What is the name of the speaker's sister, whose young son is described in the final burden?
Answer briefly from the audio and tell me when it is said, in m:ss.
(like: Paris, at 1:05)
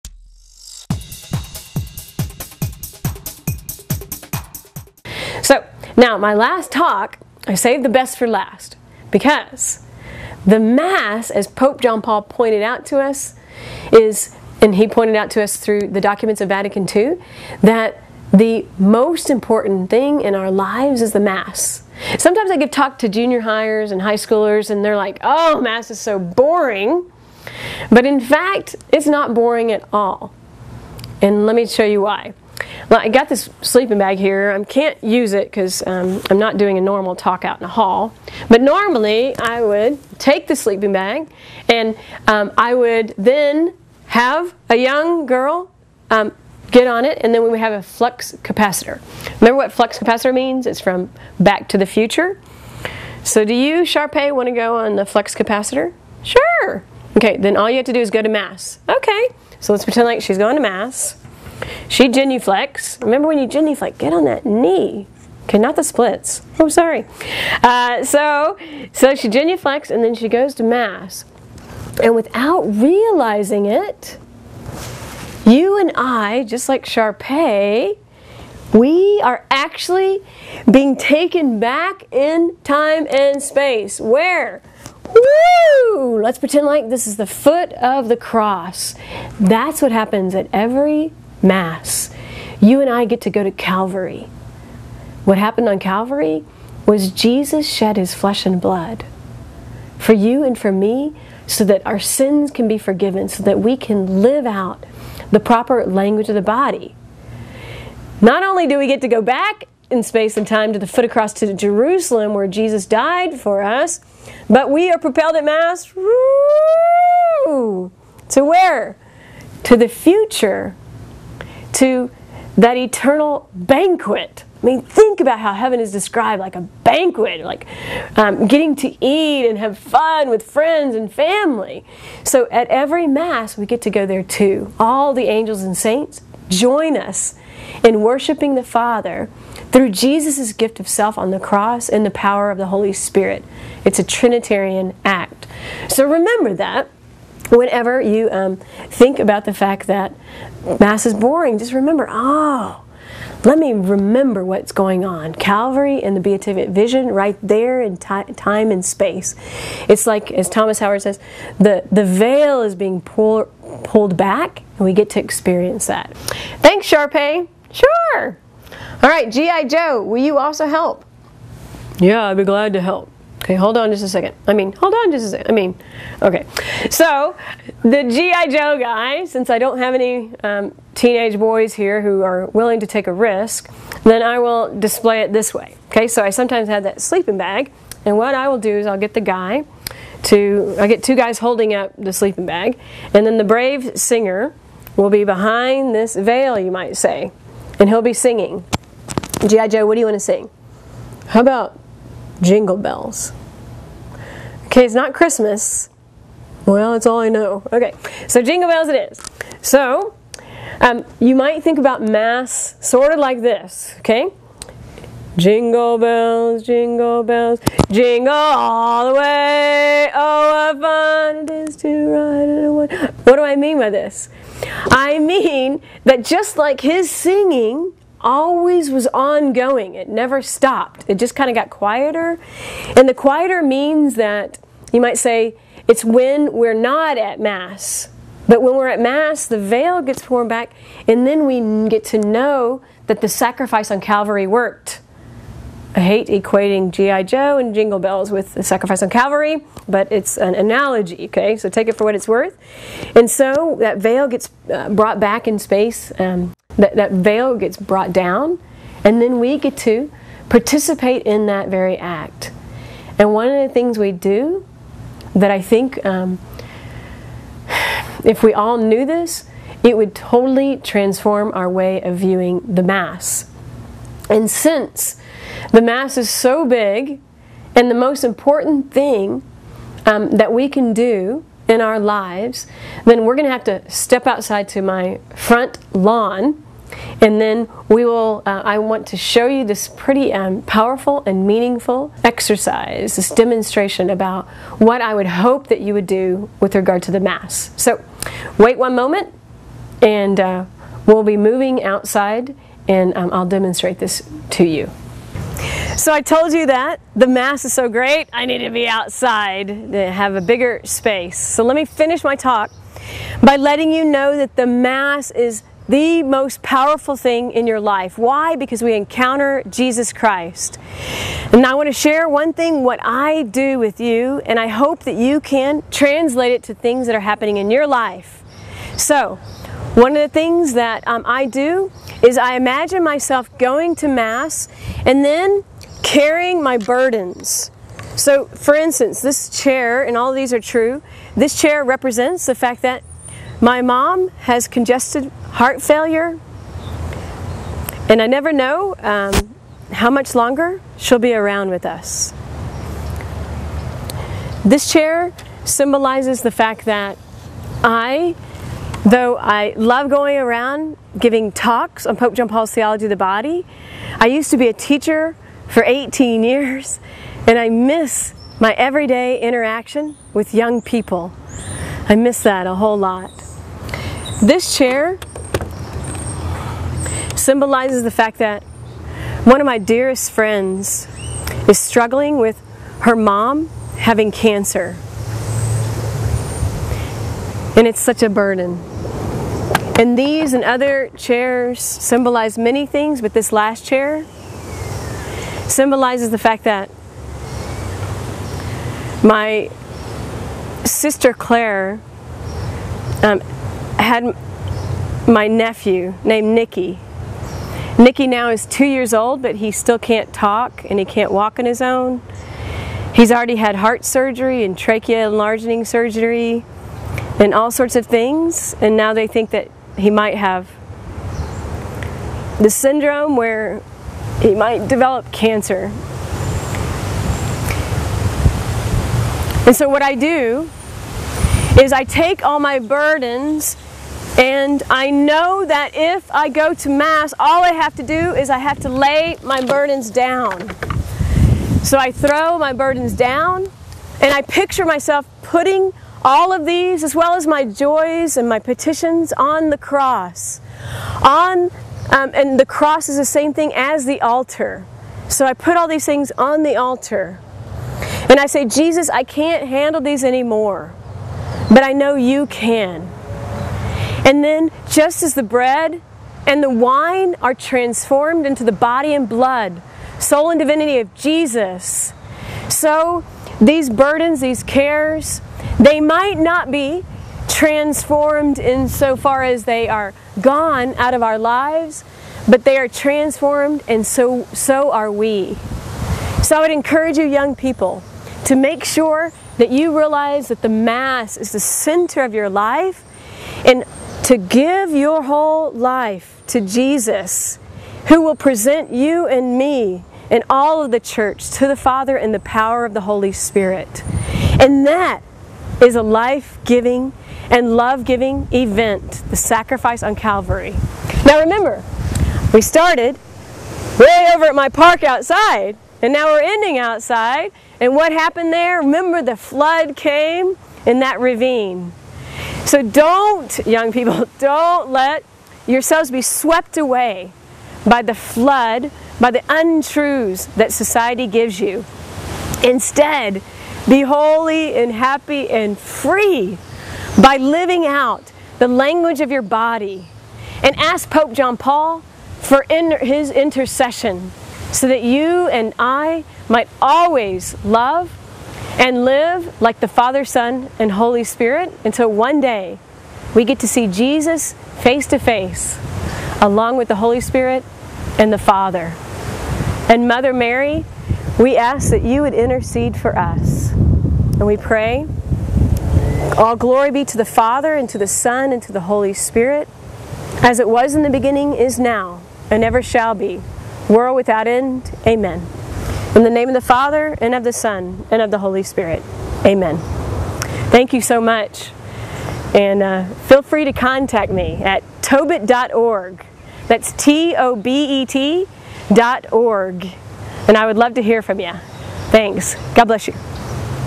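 Claire, at 6:41.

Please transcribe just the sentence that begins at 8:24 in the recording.
And that is a life giving and love giving event, the sacrifice on Calvary.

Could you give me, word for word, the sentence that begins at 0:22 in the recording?
Sometimes I give talk to junior hires and high schoolers, and they're like, oh, Mass is so boring.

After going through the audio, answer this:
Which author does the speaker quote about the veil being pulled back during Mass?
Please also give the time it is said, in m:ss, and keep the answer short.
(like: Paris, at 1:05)
Thomas Howard, at 2:40.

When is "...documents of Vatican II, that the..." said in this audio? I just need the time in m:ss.
0:15.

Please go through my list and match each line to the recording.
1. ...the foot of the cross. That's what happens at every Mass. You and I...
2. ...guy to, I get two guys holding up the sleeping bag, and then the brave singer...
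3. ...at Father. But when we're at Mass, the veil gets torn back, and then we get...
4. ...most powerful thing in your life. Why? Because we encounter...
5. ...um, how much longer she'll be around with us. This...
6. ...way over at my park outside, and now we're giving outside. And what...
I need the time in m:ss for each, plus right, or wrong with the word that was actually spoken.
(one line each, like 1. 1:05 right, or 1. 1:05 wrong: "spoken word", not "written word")
1. 1:27 right
2. 3:09 right
3. 3:57 wrong: "Mass", not "Father"
4. 5:16 right
5. 5:48 right
6. 8:33 wrong: "ending", not "giving".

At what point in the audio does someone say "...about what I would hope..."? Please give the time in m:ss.
4:54.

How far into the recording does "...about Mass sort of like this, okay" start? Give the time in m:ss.
3:31.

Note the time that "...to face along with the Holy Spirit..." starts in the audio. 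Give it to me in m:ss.
9:15.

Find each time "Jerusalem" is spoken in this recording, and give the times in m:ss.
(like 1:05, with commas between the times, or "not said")
1:51.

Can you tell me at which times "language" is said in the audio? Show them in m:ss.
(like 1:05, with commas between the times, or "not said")
1:45, 8:58.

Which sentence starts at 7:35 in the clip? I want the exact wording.
So I put all these things on the altar.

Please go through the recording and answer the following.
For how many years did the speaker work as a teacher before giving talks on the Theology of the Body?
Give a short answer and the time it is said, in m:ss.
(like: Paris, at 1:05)
18, at 6:05.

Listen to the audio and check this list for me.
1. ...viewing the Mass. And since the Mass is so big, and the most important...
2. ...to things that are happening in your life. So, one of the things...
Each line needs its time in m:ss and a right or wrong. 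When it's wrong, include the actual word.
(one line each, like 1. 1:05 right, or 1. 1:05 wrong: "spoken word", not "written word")
1. 4:32 right
2. 5:26 right.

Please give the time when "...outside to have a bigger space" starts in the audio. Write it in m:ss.
5:08.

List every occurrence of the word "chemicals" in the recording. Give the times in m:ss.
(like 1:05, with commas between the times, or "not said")
not said.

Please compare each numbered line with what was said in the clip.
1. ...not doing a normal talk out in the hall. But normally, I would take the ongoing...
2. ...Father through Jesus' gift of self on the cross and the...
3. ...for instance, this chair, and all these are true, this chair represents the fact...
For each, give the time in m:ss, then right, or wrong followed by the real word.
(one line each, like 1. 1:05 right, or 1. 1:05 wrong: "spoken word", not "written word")
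1. 0:36 wrong: "sleeping", not "ongoing"
2. 2:18 right
3. 5:38 right.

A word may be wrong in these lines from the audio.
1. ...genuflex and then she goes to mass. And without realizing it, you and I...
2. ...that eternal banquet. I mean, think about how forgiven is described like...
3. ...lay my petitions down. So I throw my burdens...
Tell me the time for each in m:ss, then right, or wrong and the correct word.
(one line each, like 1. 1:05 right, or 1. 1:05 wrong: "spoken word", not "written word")
1. 1:09 right
2. 2:02 wrong: "heaven", not "forgiven"
3. 7:18 wrong: "burdens", not "petitions".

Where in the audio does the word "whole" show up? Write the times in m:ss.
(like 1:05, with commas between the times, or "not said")
6:12, 8:15.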